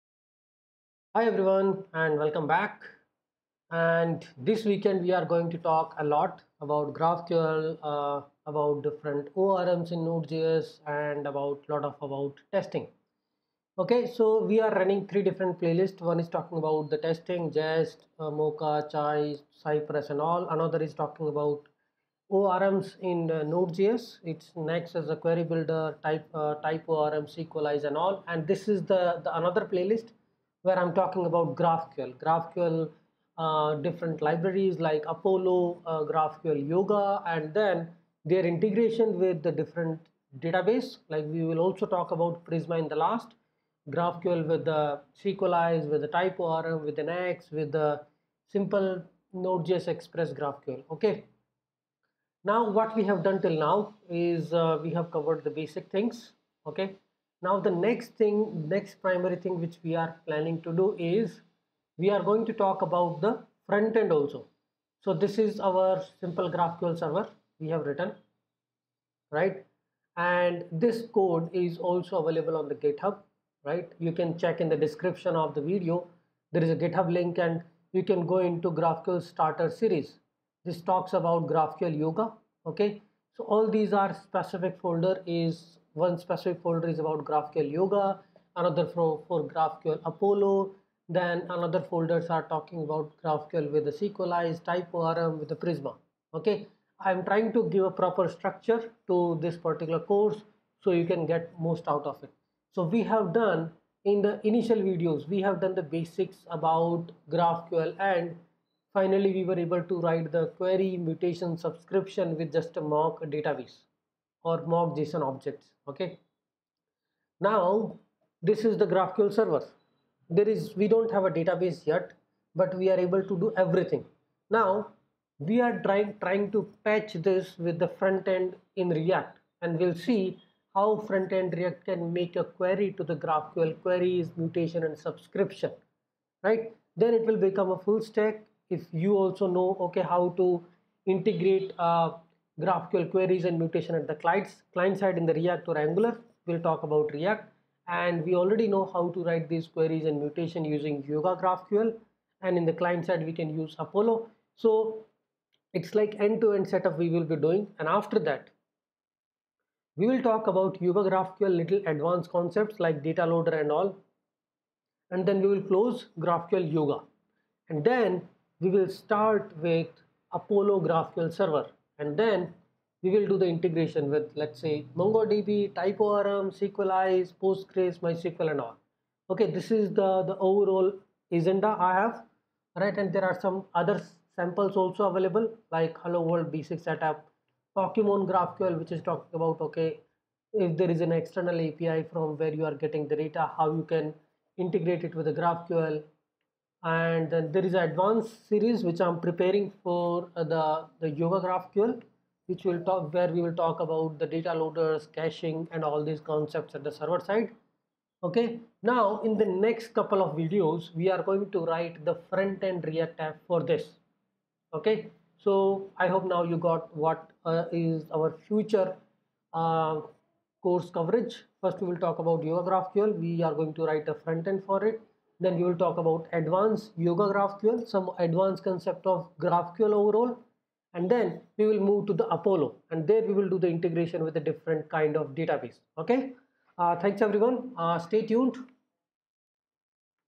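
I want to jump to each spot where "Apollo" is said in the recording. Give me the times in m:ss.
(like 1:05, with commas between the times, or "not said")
0:35, 1:30, 2:33, 2:50, 3:52.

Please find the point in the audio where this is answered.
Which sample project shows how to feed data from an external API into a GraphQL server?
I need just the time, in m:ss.
3:07.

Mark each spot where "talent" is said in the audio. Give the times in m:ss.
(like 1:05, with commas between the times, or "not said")
not said.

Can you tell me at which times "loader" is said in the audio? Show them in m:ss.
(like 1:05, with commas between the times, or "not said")
2:43, 3:24.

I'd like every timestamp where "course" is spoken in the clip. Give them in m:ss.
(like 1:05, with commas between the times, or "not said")
1:39, 3:40.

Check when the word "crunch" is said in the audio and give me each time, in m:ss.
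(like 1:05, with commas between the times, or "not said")
not said.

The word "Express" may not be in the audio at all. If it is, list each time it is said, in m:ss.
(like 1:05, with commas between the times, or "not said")
0:49.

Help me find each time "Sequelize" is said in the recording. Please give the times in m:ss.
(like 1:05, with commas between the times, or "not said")
0:27, 0:45, 2:56.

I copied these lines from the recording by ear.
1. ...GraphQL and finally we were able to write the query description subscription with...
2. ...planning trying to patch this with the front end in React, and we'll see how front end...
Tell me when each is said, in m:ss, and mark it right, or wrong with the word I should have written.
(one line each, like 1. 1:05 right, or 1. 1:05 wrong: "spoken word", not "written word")
1. 1:47 wrong: "mutation", not "description"
2. 2:05 wrong: "trying", not "planning".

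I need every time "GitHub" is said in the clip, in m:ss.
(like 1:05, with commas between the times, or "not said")
1:12, 1:16.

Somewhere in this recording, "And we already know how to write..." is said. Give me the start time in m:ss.
2:27.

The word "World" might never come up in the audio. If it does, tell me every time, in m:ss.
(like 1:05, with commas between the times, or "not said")
3:06.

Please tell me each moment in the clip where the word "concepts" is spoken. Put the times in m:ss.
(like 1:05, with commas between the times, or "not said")
2:42, 3:26, 3:48.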